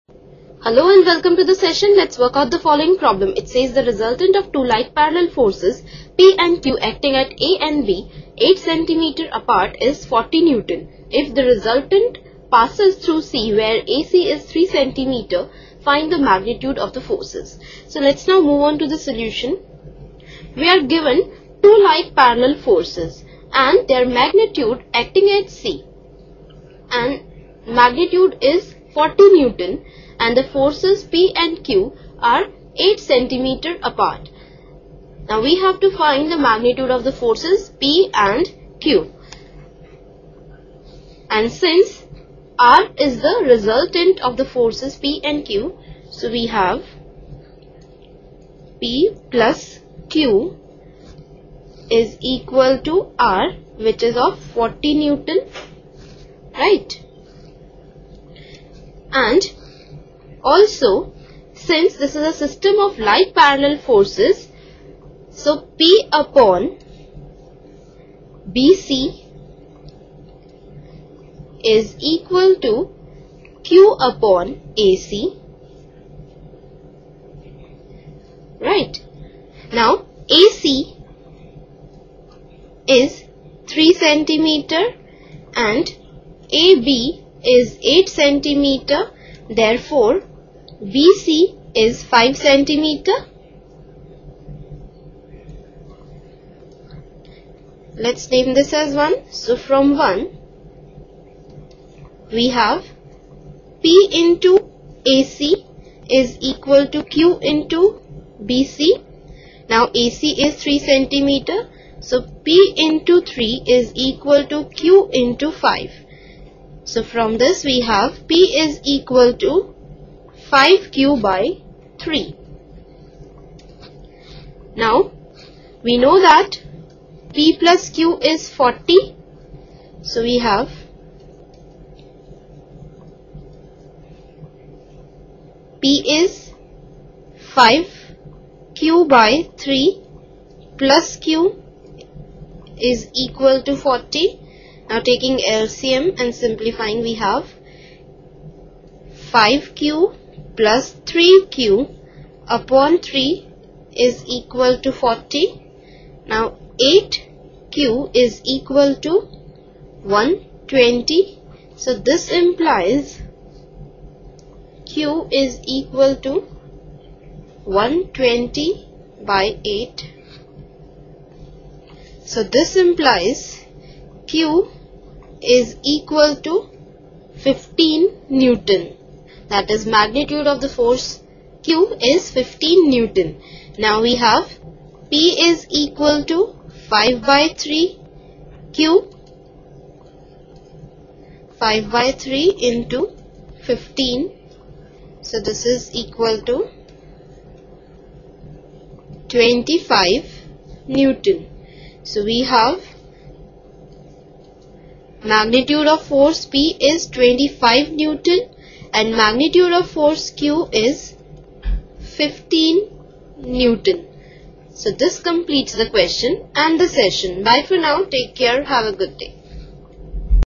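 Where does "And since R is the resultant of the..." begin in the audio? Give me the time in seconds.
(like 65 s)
41 s.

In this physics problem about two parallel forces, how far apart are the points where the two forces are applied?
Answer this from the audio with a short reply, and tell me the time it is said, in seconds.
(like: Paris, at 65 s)
8 cm, at 8 s.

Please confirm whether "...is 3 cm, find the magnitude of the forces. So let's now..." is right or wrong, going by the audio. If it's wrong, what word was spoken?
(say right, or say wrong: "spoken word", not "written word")
right.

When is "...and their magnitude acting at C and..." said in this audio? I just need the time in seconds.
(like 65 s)
23 s.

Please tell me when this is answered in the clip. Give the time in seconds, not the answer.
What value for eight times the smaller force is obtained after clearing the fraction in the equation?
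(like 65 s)
156 s.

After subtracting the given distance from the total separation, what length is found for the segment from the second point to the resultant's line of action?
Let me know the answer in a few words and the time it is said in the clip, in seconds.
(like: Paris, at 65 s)
5 centimeter, at 91 s.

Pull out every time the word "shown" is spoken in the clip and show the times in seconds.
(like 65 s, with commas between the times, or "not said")
not said.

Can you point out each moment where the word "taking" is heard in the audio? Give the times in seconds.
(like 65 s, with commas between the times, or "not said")
144 s.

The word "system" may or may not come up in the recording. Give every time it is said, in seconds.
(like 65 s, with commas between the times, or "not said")
62 s.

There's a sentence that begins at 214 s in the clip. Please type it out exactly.
So this completes the question and the session.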